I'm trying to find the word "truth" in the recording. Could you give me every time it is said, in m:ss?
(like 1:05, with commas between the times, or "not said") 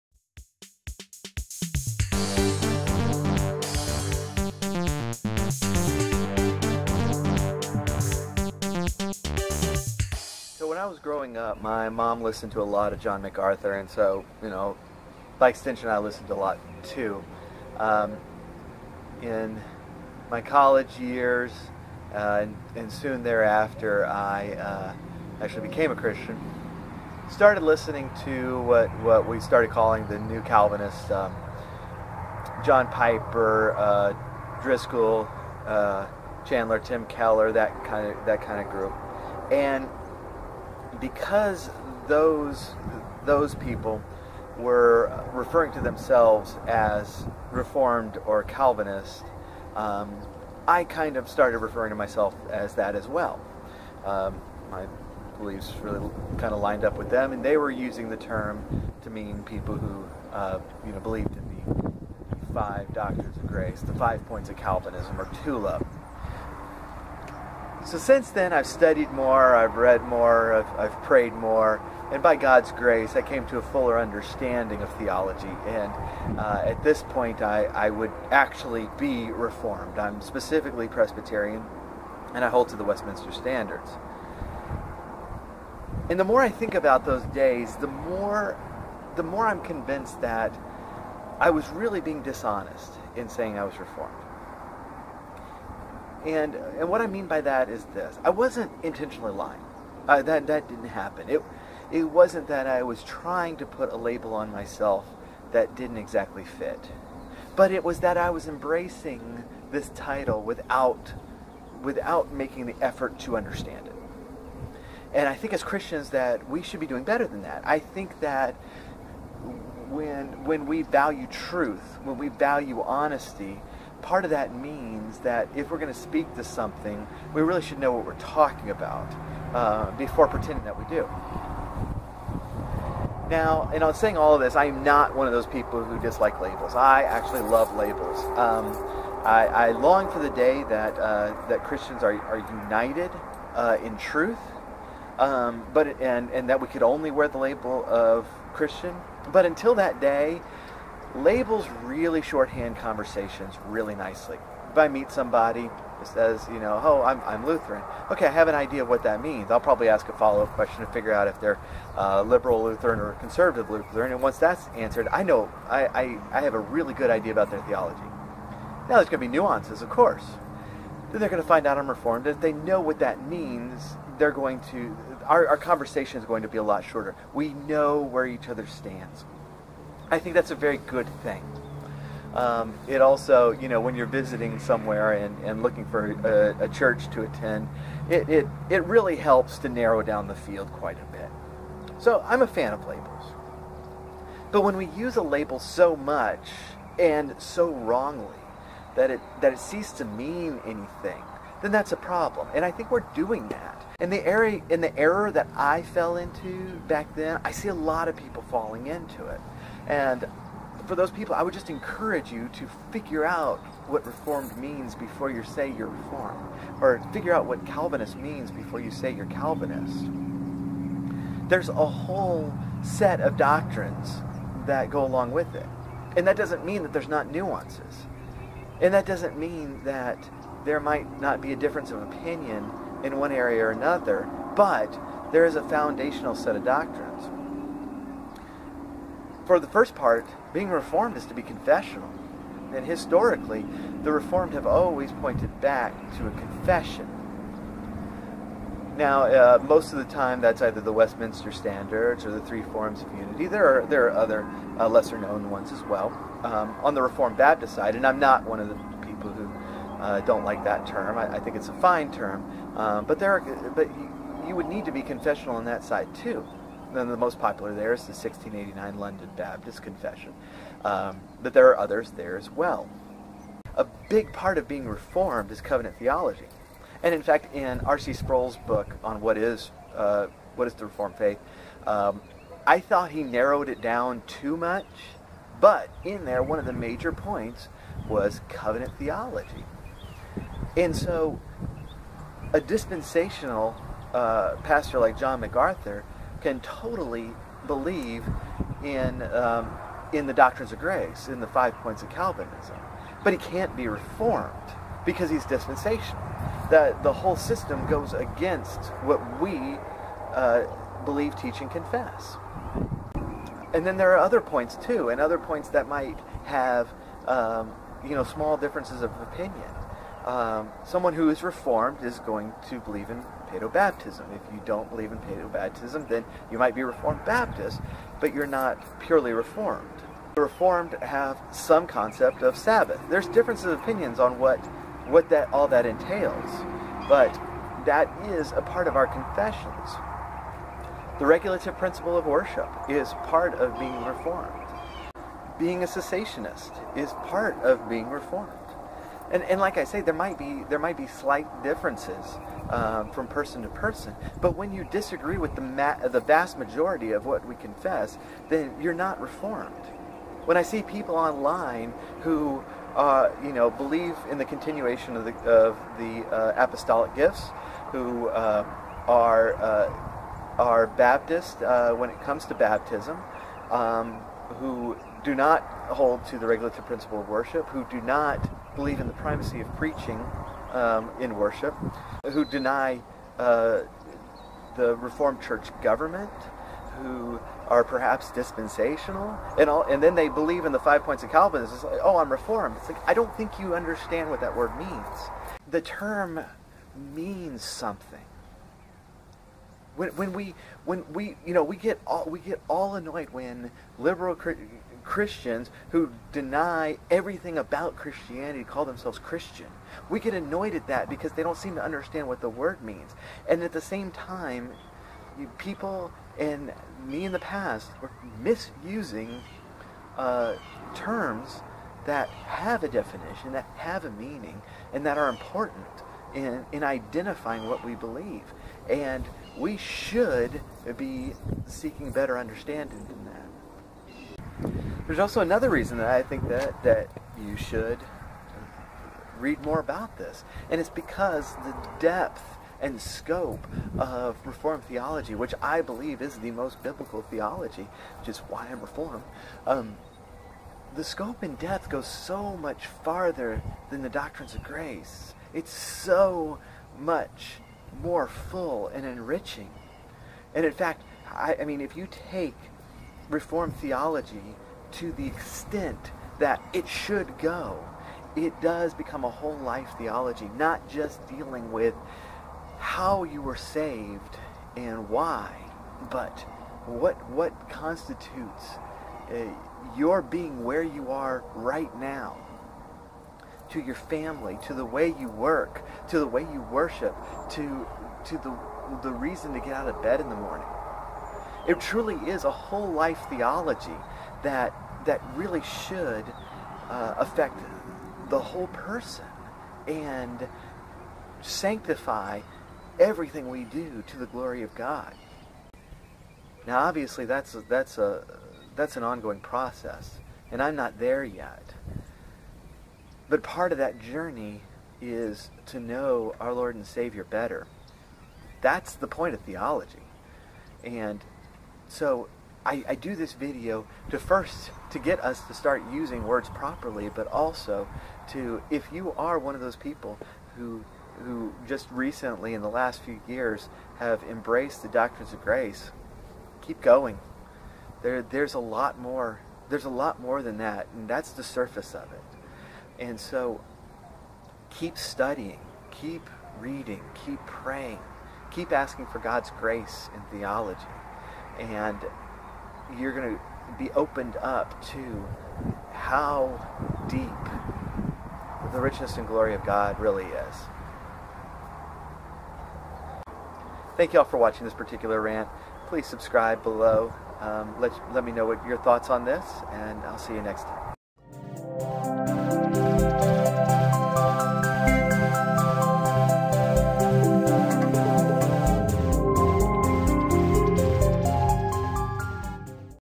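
2:01, 2:23.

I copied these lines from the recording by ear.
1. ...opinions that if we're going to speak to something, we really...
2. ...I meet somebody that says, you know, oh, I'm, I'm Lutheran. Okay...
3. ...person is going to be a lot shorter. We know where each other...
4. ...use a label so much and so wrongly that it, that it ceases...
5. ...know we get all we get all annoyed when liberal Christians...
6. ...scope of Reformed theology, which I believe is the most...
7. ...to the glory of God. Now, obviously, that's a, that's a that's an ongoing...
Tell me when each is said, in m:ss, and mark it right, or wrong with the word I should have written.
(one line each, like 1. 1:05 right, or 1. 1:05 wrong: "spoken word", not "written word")
1. 2:04 wrong: "means", not "opinions"
2. 2:34 right
3. 2:55 wrong: "conversation", not "person"
4. 3:14 right
5. 6:41 right
6. 7:23 right
7. 8:24 right.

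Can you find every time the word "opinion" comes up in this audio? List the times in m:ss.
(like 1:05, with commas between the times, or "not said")
3:52, 5:19, 5:33.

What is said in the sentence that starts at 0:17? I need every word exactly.
Um, in my college years, uh, and, and, soon thereafter, I uh, actually became a Christian.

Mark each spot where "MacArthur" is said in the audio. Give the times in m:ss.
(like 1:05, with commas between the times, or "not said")
0:13, 4:55.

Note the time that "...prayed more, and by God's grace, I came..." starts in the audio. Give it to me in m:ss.
1:11.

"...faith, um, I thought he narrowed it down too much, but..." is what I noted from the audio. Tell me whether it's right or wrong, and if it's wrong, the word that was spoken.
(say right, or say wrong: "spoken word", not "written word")
right.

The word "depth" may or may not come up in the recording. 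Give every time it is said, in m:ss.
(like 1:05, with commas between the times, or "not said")
7:21, 7:31.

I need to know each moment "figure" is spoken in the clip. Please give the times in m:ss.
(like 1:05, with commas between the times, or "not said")
2:40, 3:32, 3:37.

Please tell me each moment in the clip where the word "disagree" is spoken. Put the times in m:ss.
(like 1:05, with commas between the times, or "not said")
5:54.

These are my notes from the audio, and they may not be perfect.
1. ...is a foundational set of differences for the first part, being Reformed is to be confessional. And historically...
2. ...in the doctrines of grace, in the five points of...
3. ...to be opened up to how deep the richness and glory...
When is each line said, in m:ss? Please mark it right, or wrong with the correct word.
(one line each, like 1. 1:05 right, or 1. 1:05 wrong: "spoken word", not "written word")
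1. 3:55 wrong: "doctrines", not "differences"
2. 5:00 right
3. 9:13 right.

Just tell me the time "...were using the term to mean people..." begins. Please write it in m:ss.
0:57.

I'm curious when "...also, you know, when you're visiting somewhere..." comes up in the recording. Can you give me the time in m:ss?
3:03.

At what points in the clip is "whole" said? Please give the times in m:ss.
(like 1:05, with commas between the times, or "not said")
3:41, 5:07, 7:49, 8:12, 8:18.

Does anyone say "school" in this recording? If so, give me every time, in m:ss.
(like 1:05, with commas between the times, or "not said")
not said.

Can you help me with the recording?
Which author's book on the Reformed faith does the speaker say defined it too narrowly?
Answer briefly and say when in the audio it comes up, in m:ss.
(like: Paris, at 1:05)
R.C. Sproul, at 4:37.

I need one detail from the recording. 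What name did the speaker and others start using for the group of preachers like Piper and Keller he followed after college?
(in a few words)
New Calvinists.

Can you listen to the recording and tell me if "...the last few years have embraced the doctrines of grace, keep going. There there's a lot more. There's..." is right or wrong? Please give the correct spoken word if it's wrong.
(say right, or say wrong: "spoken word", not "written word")
right.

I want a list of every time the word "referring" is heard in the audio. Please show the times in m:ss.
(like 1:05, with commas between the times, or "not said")
0:45, 0:51.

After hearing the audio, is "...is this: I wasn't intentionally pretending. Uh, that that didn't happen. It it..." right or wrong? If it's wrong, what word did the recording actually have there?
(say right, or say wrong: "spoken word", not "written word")
wrong: "lying", not "pretending".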